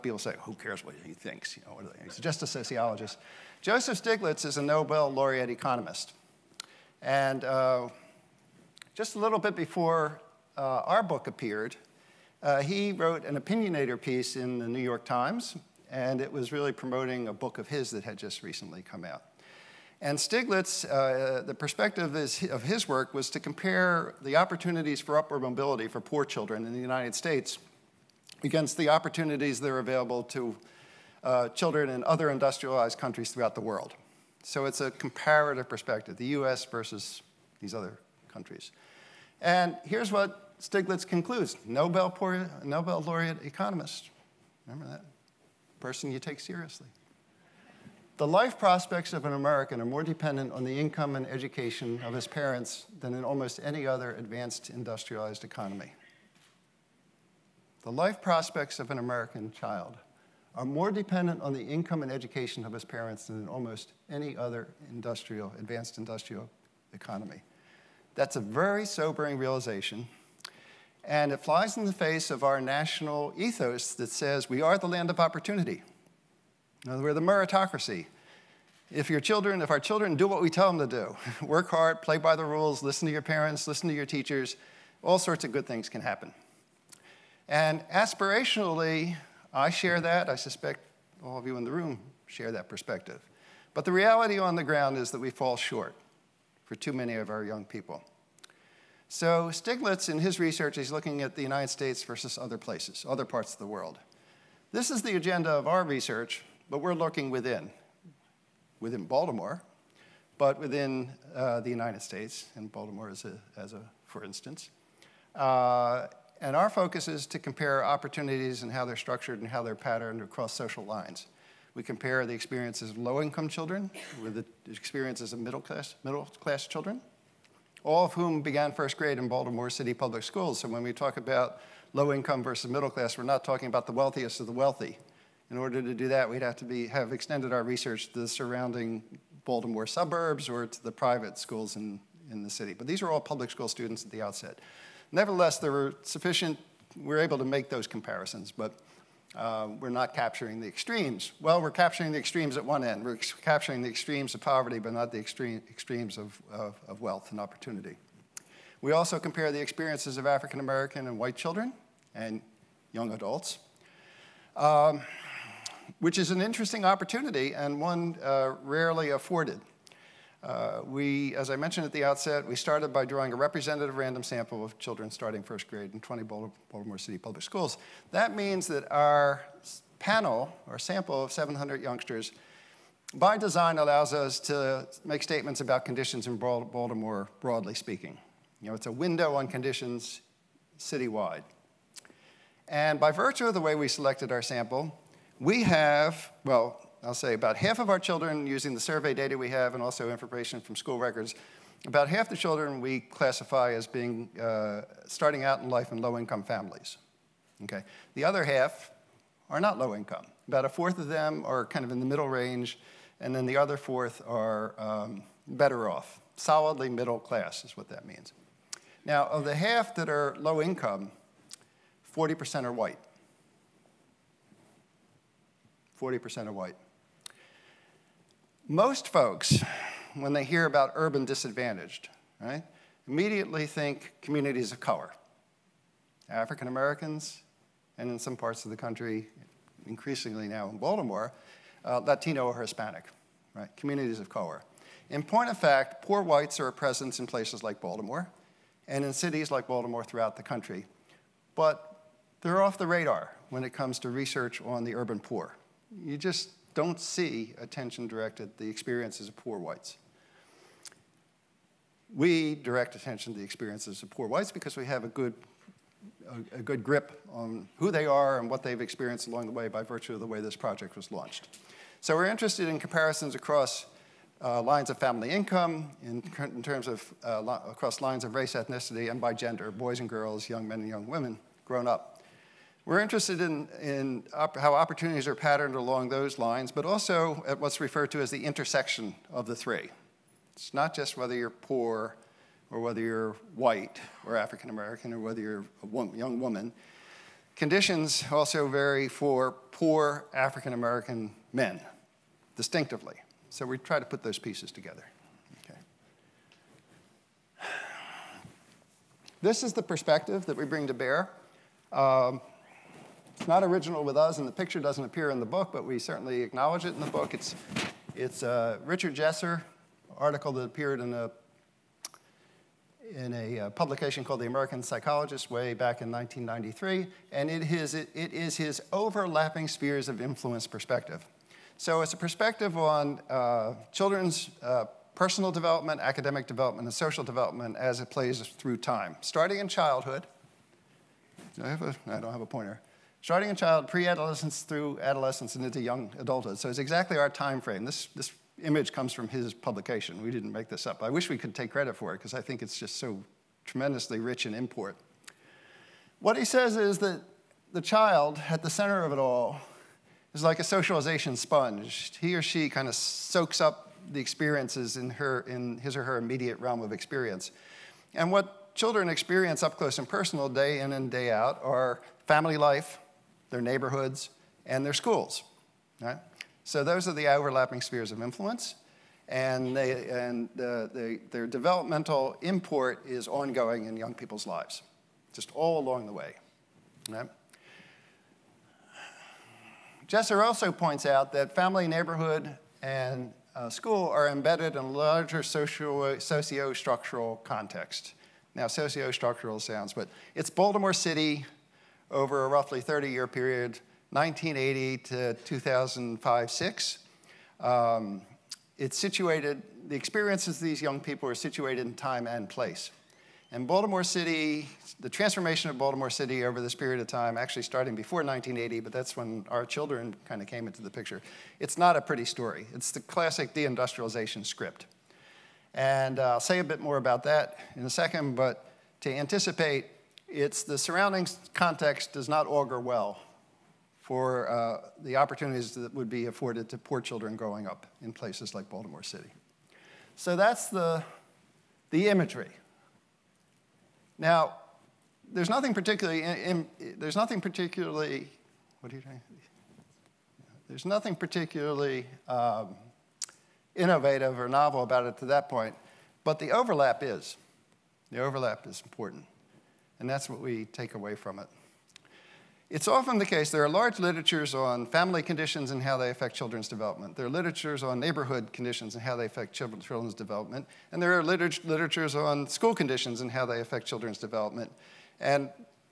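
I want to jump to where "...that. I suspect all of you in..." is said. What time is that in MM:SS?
01:29.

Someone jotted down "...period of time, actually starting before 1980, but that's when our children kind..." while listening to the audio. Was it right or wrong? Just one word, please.
right.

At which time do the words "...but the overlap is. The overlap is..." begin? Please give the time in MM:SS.
07:36.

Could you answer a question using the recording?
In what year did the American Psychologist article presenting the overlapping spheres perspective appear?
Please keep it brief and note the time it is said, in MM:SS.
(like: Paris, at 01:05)
1993, at 05:26.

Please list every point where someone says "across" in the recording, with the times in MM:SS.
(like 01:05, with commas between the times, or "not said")
02:00, 04:33, 04:37.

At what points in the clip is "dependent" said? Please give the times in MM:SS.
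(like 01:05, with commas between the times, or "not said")
00:50, 01:00.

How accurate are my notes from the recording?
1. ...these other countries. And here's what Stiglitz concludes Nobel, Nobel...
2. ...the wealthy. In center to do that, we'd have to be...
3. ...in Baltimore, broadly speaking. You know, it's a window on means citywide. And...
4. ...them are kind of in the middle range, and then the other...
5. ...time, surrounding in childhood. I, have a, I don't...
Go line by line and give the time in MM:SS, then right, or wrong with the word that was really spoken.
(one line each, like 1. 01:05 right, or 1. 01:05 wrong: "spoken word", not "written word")
1. 00:37 right
2. 02:14 wrong: "order", not "center"
3. 03:06 wrong: "conditions", not "means"
4. 03:31 right
5. 05:38 wrong: "starting", not "surrounding".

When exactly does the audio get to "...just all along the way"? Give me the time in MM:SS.
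06:25.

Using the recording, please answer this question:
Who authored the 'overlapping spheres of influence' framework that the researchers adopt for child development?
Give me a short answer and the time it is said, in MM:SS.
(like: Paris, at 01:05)
Richard Jessor, at 05:18.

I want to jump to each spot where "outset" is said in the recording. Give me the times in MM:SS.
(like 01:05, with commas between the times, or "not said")
02:24, 02:52.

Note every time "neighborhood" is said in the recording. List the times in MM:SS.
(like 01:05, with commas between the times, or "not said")
06:13, 06:31, 07:48.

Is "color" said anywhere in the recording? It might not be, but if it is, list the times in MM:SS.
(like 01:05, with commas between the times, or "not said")
03:54, 04:04.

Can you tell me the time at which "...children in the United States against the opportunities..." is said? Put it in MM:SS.
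00:26.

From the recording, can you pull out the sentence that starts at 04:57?
Conditions also vary for poor African American men distinctively.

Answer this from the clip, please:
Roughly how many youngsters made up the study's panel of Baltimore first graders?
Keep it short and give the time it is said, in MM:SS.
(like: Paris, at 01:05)
700, at 03:01.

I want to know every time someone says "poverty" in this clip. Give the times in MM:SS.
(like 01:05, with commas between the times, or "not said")
02:34.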